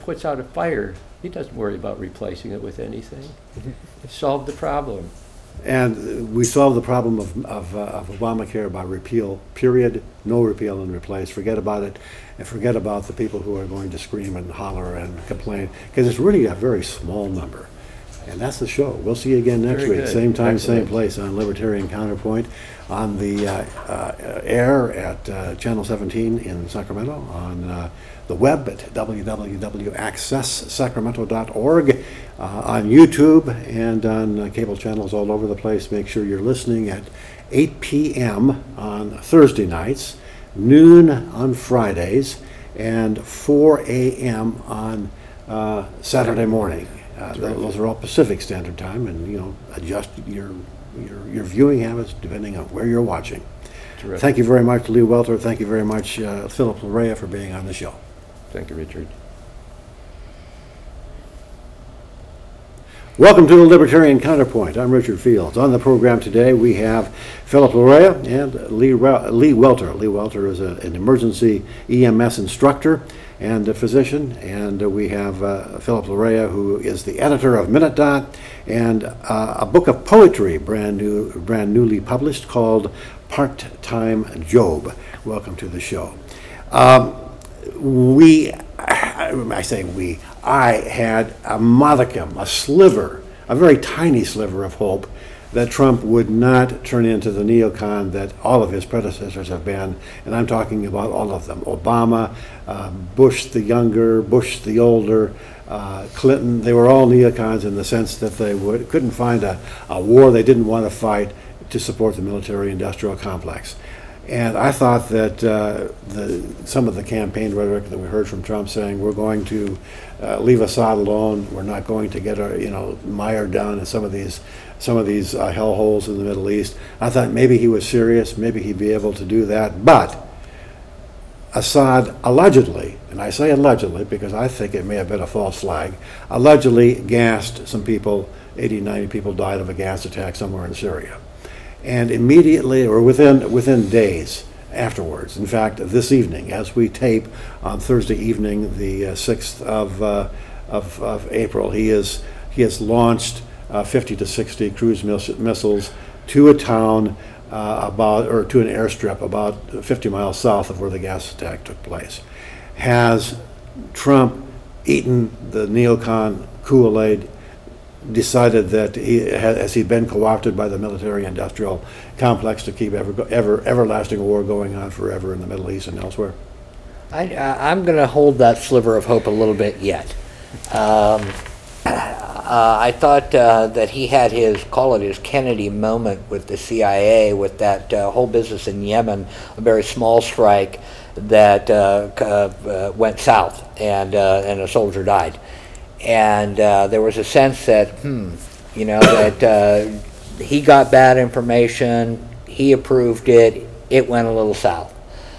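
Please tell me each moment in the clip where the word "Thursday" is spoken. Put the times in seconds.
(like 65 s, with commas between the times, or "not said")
39 s, 147 s.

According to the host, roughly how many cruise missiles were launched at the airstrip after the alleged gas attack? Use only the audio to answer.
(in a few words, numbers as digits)
50 to 60.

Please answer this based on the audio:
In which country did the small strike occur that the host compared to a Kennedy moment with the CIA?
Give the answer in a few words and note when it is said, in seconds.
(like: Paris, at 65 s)
Yemen, at 188 s.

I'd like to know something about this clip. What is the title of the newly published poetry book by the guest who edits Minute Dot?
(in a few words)
Part Time Job.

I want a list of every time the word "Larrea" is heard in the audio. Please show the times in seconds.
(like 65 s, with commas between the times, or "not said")
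56 s, 67 s, 76 s.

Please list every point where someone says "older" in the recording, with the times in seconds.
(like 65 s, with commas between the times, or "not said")
104 s.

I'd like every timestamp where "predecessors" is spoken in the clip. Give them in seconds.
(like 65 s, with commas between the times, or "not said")
98 s.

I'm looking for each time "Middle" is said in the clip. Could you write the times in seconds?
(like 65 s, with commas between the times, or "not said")
126 s, 175 s.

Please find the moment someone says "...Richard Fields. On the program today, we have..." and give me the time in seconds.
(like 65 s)
64 s.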